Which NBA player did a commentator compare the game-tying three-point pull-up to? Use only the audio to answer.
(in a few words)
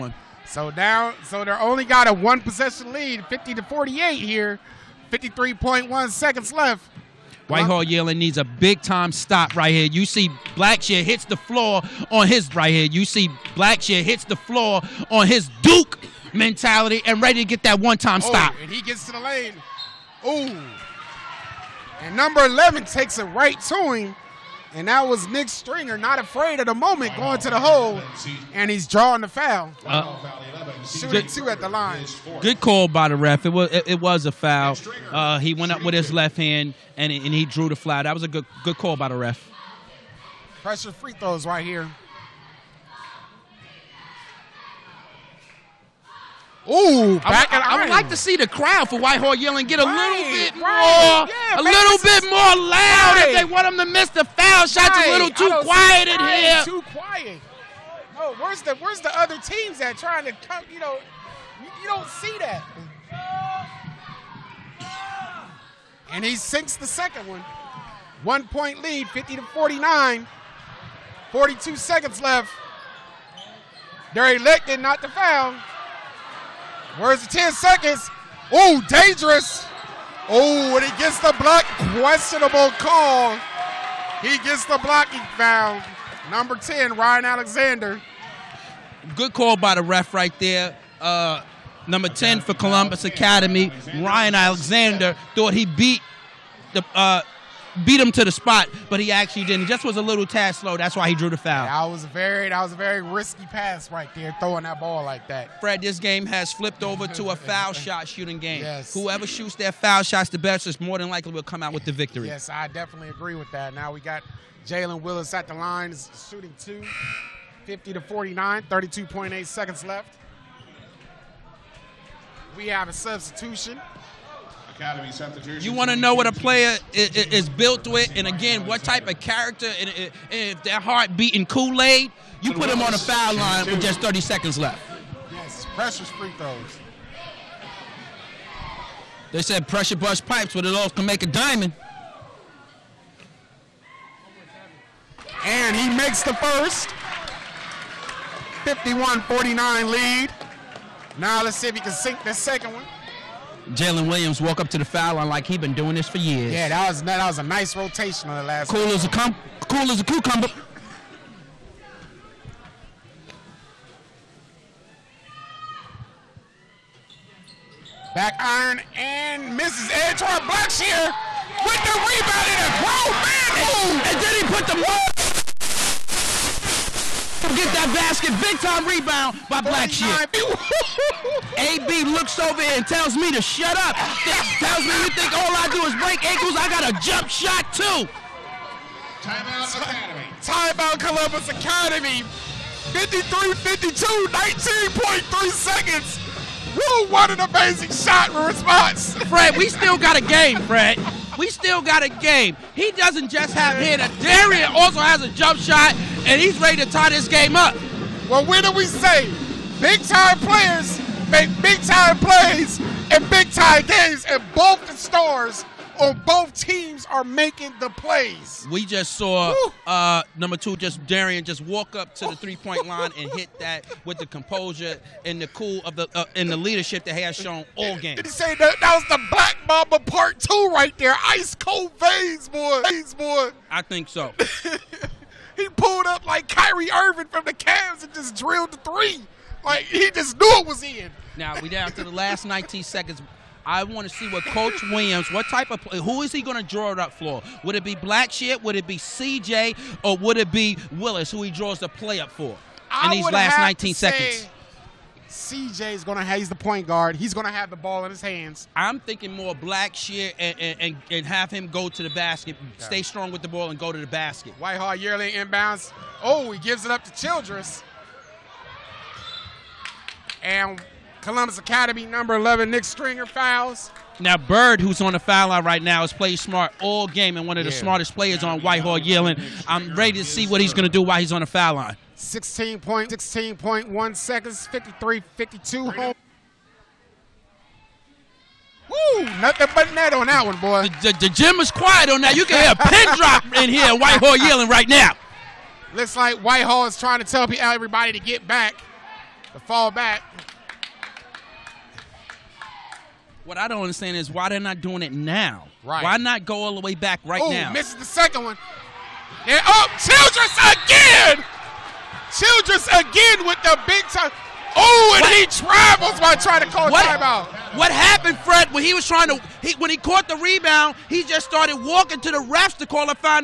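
Kyrie Irving.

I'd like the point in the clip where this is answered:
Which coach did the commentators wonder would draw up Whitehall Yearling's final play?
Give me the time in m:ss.
4:04.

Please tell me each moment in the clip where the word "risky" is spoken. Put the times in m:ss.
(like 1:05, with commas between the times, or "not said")
1:43.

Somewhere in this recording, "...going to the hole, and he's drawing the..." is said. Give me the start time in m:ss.
0:27.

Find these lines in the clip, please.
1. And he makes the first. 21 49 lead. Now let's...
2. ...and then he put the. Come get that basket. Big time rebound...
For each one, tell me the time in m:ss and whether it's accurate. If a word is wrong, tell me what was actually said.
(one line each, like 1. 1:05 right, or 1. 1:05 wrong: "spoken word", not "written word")
1. 2:25 wrong: "51", not "21"
2. 2:54 right.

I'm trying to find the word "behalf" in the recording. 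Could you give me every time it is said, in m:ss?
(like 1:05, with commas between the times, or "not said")
not said.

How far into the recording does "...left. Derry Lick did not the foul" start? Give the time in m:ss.
1:12.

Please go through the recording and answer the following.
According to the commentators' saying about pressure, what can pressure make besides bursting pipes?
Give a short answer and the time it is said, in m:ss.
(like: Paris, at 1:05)
a diamond, at 2:21.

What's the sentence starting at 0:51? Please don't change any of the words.
more, yeah, a little bit more loud right.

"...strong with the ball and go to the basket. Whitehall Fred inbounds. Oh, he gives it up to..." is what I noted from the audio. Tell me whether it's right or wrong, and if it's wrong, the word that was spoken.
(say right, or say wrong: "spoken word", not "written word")
wrong: "Yearling", not "Fred".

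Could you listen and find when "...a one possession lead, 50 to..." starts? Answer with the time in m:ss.
0:02.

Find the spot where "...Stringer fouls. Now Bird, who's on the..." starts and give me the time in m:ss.
4:32.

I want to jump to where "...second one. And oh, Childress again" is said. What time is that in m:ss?
5:08.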